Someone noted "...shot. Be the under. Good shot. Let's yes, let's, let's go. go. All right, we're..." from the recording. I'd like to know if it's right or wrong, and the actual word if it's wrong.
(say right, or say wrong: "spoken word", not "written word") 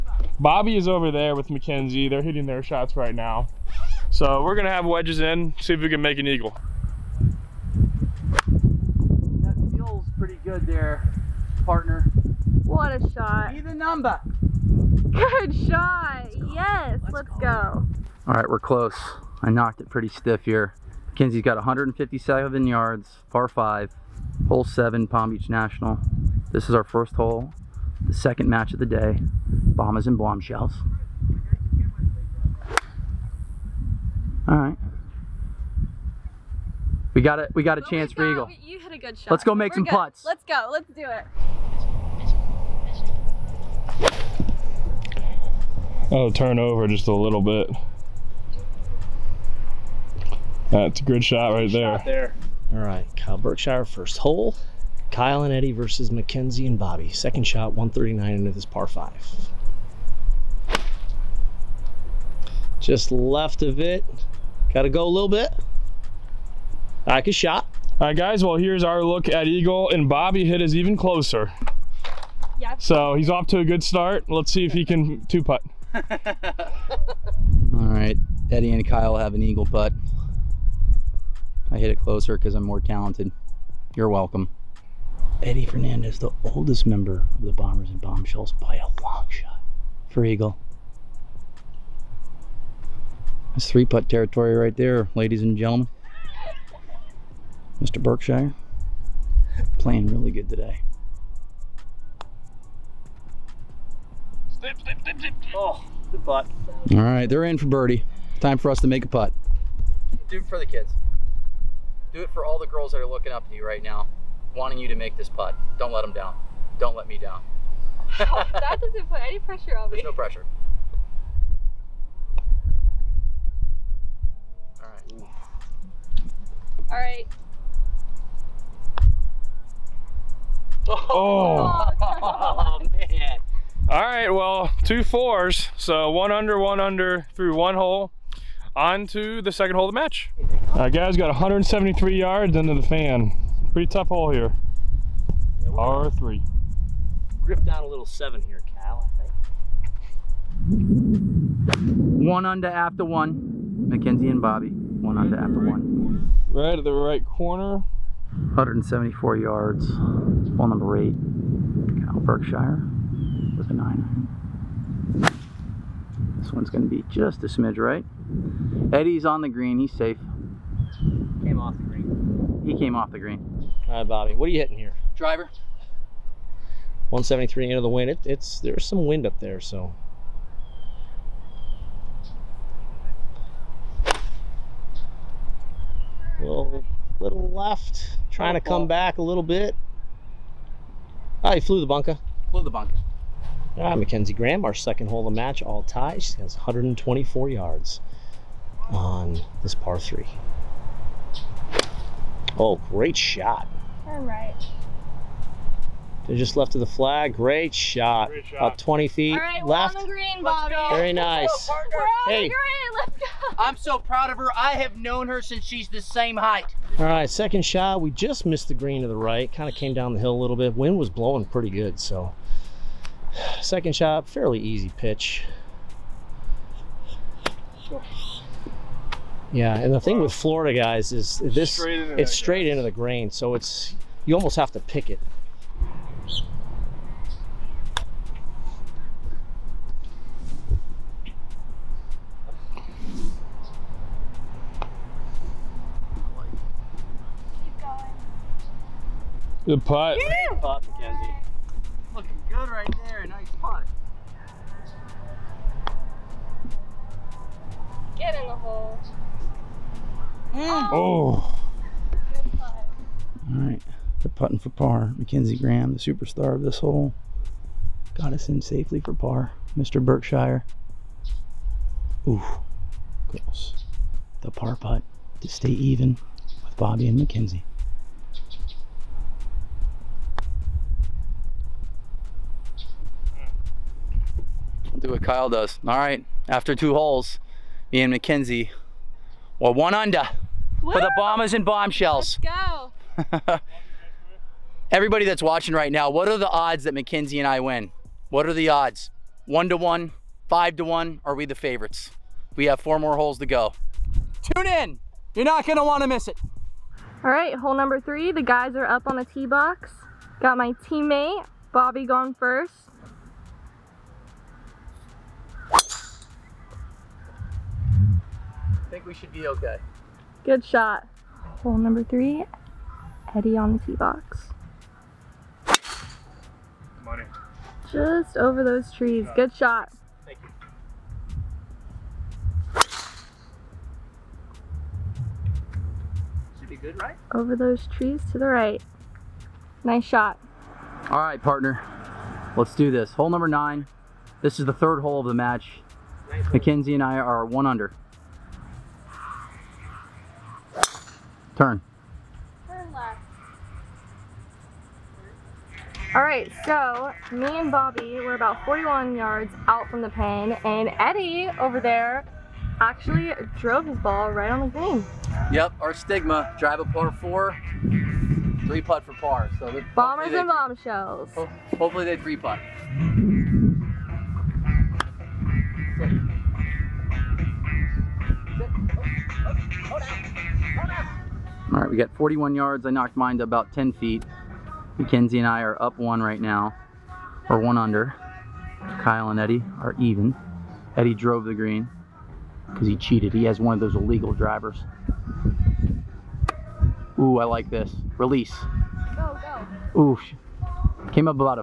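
wrong: "number", not "under".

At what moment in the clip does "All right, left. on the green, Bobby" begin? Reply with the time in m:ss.
3:29.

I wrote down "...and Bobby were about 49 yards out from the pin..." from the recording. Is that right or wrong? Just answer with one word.
wrong.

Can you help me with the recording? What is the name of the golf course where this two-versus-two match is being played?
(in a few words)
Palm Beach National.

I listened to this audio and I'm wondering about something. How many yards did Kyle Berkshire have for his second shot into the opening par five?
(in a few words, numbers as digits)
139.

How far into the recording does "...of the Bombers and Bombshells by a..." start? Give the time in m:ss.
1:27.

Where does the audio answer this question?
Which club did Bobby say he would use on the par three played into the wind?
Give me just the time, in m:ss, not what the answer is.
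2:55.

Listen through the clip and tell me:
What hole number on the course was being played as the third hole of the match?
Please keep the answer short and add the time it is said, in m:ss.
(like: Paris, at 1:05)
9, at 5:43.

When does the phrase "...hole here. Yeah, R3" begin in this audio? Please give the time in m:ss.
2:24.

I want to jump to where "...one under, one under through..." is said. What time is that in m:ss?
2:16.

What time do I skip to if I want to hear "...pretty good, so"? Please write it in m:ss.
3:41.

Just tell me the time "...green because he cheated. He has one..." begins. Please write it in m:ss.
6:31.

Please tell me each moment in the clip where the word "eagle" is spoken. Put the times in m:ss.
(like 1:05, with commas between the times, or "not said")
0:06, 0:38, 1:09, 1:19, 1:30.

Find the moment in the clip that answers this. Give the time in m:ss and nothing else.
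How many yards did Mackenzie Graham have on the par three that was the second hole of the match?
3:16.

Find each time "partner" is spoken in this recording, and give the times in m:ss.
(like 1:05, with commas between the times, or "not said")
0:11, 5:41.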